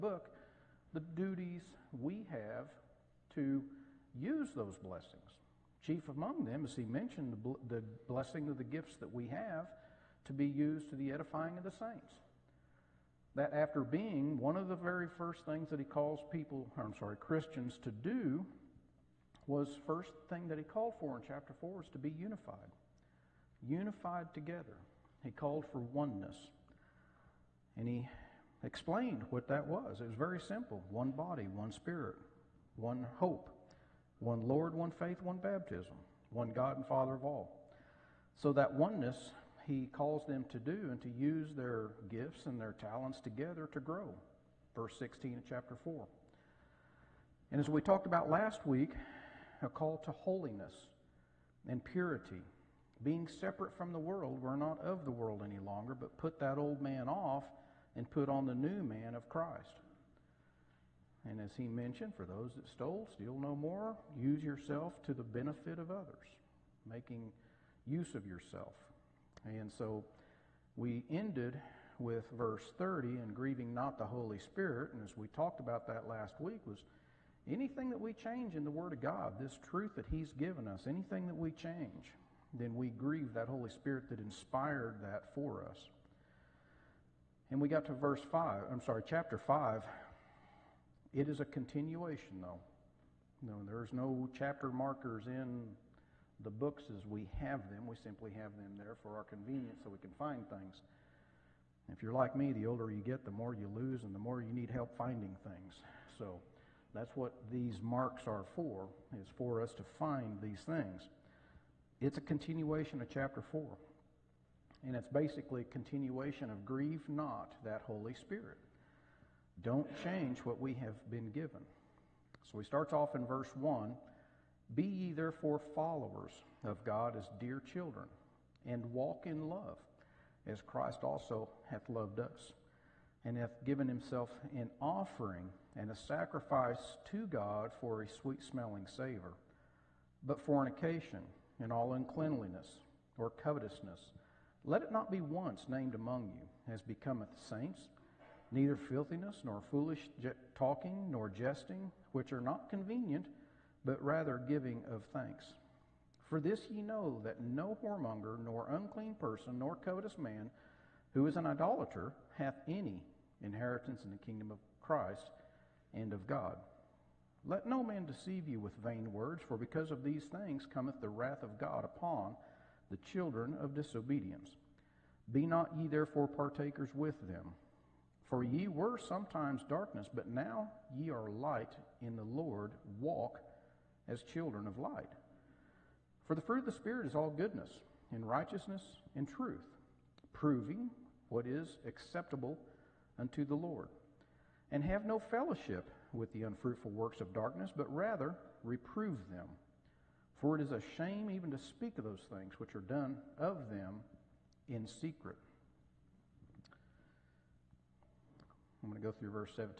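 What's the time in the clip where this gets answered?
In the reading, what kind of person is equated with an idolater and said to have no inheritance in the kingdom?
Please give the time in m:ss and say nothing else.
2:39.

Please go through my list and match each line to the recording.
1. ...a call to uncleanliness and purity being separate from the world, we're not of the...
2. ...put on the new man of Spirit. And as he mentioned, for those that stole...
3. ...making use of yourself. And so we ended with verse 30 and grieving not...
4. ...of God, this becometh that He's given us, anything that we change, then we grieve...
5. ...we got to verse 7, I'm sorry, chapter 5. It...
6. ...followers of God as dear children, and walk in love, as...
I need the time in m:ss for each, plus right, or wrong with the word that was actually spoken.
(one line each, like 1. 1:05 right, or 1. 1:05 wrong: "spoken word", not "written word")
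1. 0:49 wrong: "holiness", not "uncleanliness"
2. 0:58 wrong: "Christ", not "Spirit"
3. 1:06 right
4. 1:18 wrong: "truth", not "becometh"
5. 1:27 wrong: "5", not "7"
6. 2:05 right.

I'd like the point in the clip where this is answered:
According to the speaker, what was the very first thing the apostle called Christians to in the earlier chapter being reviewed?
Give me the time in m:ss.
0:23.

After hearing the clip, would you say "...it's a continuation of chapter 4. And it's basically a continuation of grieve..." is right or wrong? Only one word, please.
right.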